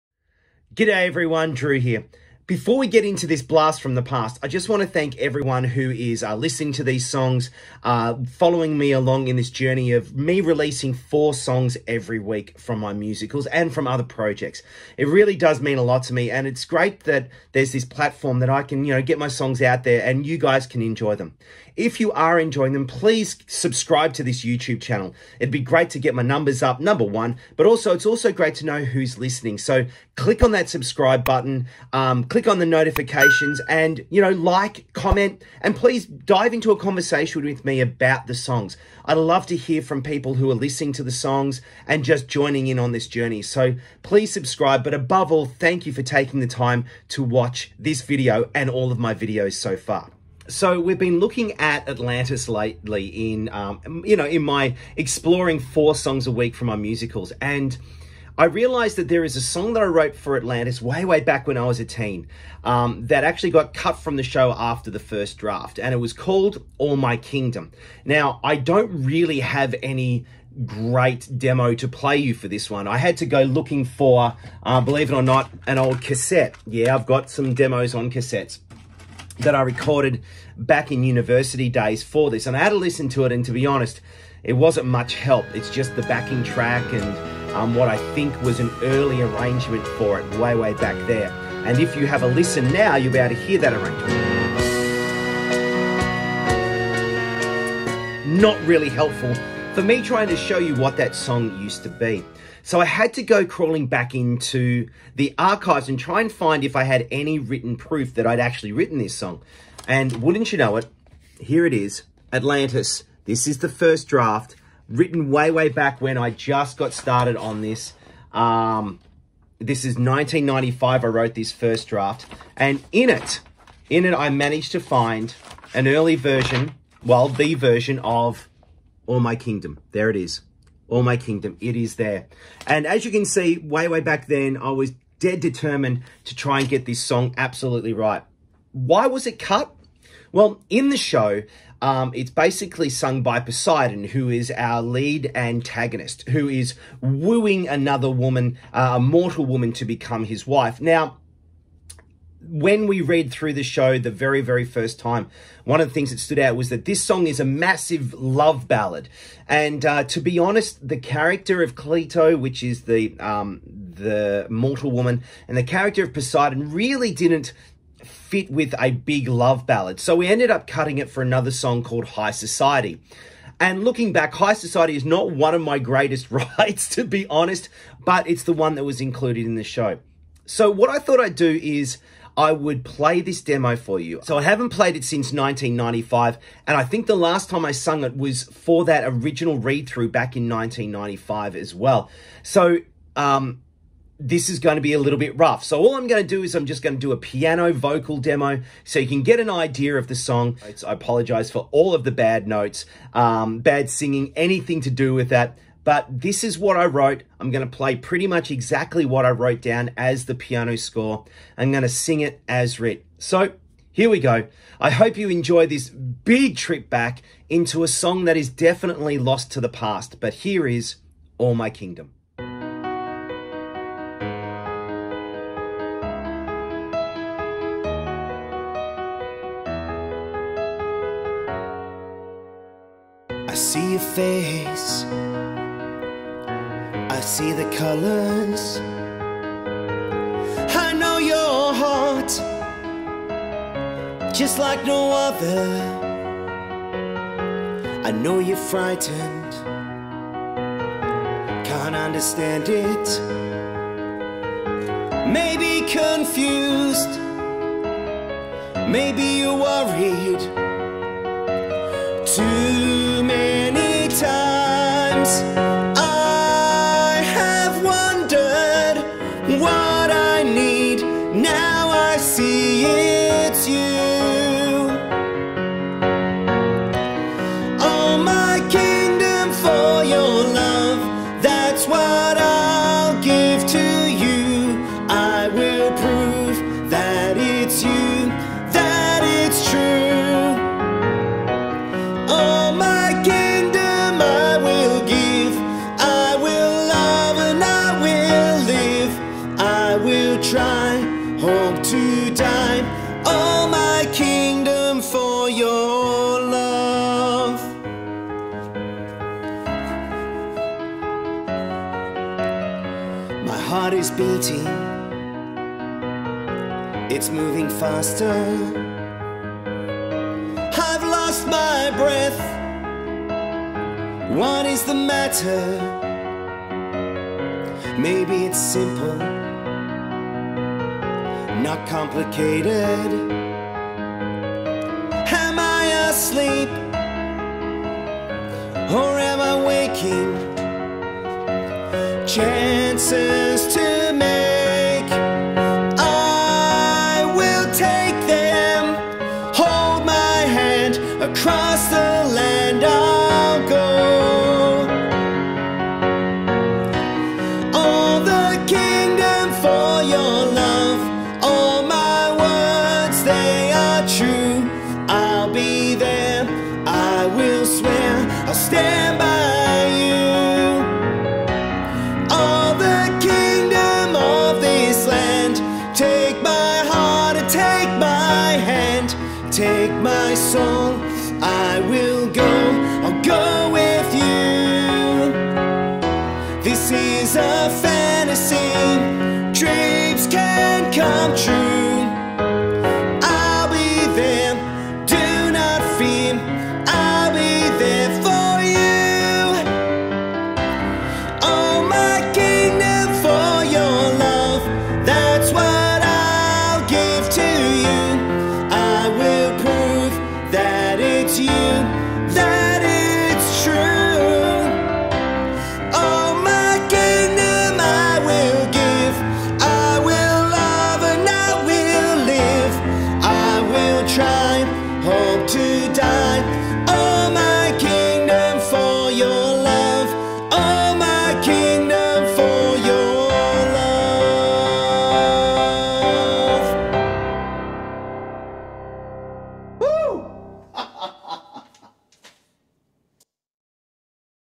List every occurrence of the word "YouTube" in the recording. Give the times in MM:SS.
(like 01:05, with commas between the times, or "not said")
00:24.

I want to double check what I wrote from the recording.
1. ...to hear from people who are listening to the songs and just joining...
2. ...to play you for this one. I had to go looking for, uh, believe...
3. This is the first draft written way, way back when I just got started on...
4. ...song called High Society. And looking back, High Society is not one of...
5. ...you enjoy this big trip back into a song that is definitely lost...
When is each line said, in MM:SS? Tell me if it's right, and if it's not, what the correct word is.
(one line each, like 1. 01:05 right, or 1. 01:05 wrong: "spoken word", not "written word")
1. 00:39 right
2. 01:11 right
3. 01:53 right
4. 02:51 right
5. 03:35 right.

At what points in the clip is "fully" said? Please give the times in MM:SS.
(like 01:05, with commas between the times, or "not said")
not said.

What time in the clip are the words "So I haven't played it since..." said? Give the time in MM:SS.
03:04.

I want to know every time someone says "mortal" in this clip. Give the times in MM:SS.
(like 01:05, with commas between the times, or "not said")
02:28, 02:44.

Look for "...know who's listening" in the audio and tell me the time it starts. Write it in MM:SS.
00:28.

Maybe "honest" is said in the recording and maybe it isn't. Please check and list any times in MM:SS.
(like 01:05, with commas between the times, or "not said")
01:23, 02:40, 02:57.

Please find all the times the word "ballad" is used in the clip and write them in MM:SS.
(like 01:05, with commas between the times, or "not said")
02:38, 02:49.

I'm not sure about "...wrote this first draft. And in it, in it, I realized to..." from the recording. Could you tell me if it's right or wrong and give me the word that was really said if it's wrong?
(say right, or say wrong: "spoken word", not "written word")
wrong: "managed", not "realized".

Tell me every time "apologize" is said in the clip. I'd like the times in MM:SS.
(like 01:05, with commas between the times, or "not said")
03:20.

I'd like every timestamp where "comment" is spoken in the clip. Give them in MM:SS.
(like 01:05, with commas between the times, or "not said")
00:34.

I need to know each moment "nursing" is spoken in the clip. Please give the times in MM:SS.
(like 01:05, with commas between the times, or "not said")
not said.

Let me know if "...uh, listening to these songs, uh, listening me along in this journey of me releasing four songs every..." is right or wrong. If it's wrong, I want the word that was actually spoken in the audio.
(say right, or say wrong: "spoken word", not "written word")
wrong: "following", not "listening".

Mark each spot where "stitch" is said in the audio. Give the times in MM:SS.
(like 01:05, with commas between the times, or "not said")
not said.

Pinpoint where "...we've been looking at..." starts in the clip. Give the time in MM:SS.
00:50.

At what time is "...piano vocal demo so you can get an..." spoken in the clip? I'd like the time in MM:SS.
03:17.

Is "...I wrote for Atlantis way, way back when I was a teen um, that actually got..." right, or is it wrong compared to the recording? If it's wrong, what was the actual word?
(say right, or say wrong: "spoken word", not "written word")
right.